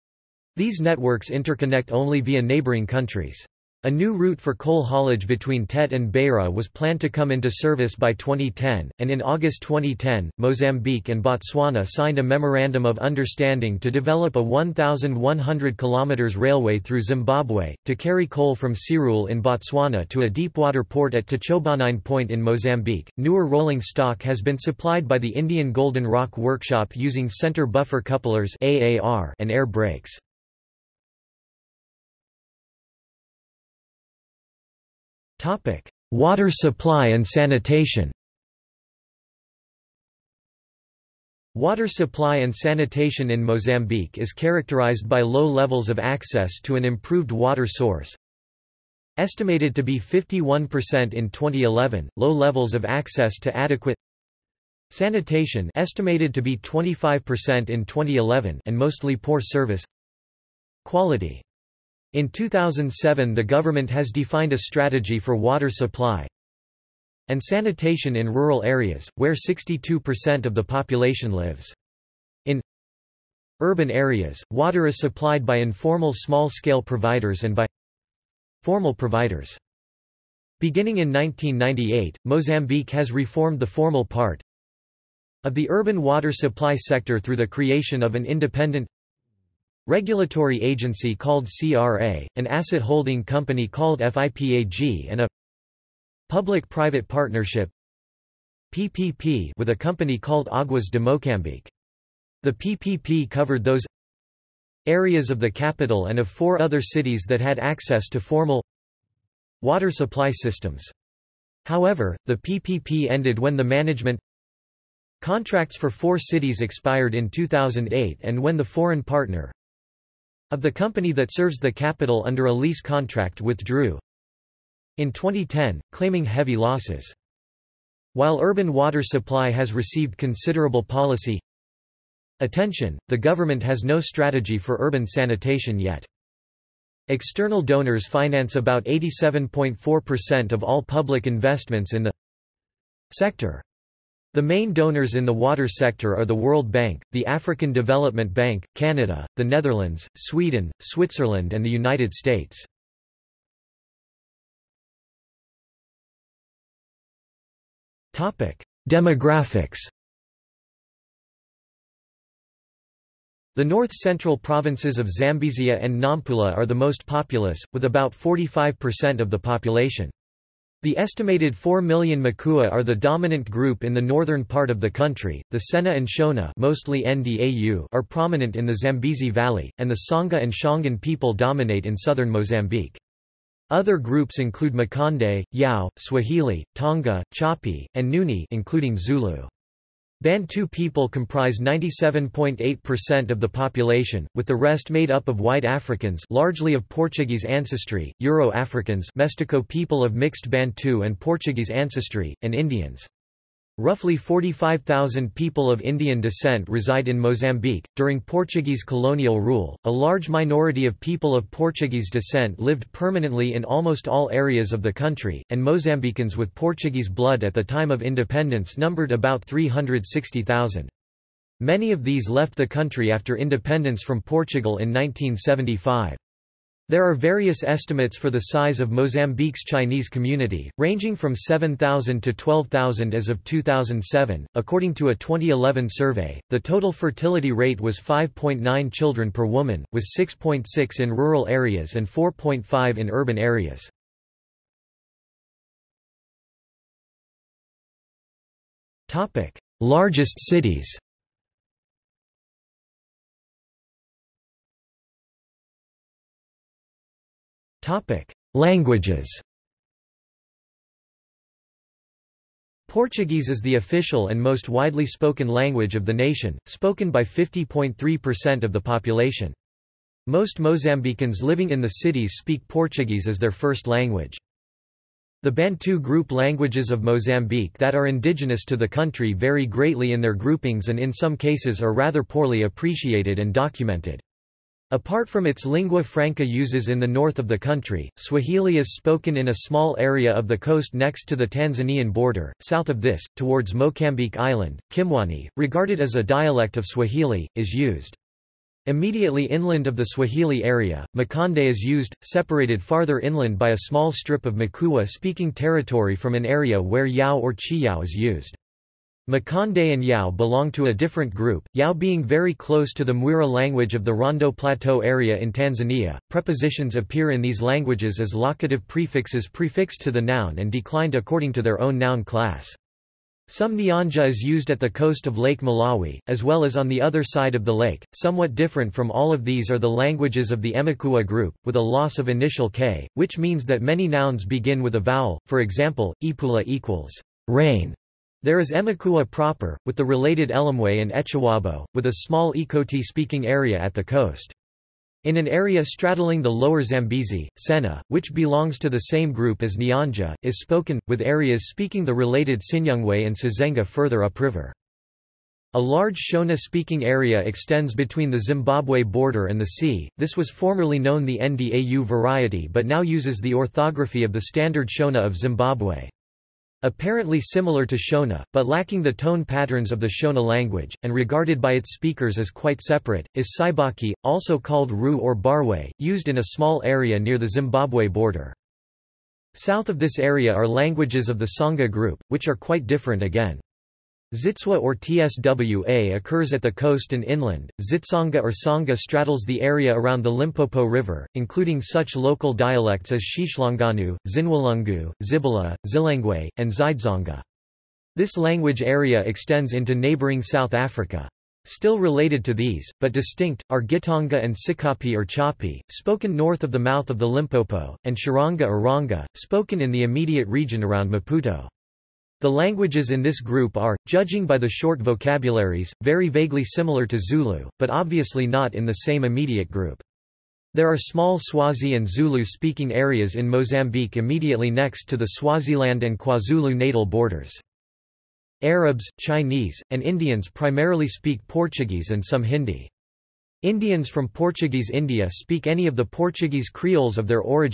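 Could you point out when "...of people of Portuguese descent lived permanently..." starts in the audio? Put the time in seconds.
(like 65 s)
210 s.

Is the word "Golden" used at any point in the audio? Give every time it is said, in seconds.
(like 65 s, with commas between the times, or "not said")
25 s.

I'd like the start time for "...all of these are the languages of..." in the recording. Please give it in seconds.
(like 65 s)
329 s.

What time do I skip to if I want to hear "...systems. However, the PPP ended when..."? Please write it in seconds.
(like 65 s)
110 s.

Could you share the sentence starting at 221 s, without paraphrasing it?
Many of these left the country after independence from Portugal in 1975.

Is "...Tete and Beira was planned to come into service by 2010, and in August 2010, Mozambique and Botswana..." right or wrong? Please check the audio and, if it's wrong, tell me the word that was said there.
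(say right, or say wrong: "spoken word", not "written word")
right.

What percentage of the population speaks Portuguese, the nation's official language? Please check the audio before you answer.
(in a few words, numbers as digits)
50.3%.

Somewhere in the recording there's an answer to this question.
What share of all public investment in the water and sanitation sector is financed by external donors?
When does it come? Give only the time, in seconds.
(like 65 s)
138 s.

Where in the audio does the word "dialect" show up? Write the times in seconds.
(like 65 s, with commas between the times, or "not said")
296 s, 392 s.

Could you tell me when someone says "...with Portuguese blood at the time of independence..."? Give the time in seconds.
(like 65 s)
216 s.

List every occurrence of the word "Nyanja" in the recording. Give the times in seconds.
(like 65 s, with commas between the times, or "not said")
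323 s, 349 s.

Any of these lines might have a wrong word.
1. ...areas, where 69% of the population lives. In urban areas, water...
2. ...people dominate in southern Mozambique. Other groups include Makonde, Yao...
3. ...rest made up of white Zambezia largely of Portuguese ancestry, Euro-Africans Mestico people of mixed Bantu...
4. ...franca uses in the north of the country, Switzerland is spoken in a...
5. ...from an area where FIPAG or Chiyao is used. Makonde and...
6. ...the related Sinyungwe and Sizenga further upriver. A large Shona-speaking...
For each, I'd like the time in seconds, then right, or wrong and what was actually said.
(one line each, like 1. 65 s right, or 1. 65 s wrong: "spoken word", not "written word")
1. 68 s wrong: "62", not "69"
2. 181 s right
3. 194 s wrong: "Africans", not "Zambezia"
4. 286 s wrong: "Swahili", not "Switzerland"
5. 306 s wrong: "Yao", not "FIPAG"
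6. 352 s right.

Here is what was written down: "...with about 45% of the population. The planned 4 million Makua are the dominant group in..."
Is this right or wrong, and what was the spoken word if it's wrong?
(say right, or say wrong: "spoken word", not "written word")
wrong: "estimated", not "planned".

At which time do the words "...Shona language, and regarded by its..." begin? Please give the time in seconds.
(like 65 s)
370 s.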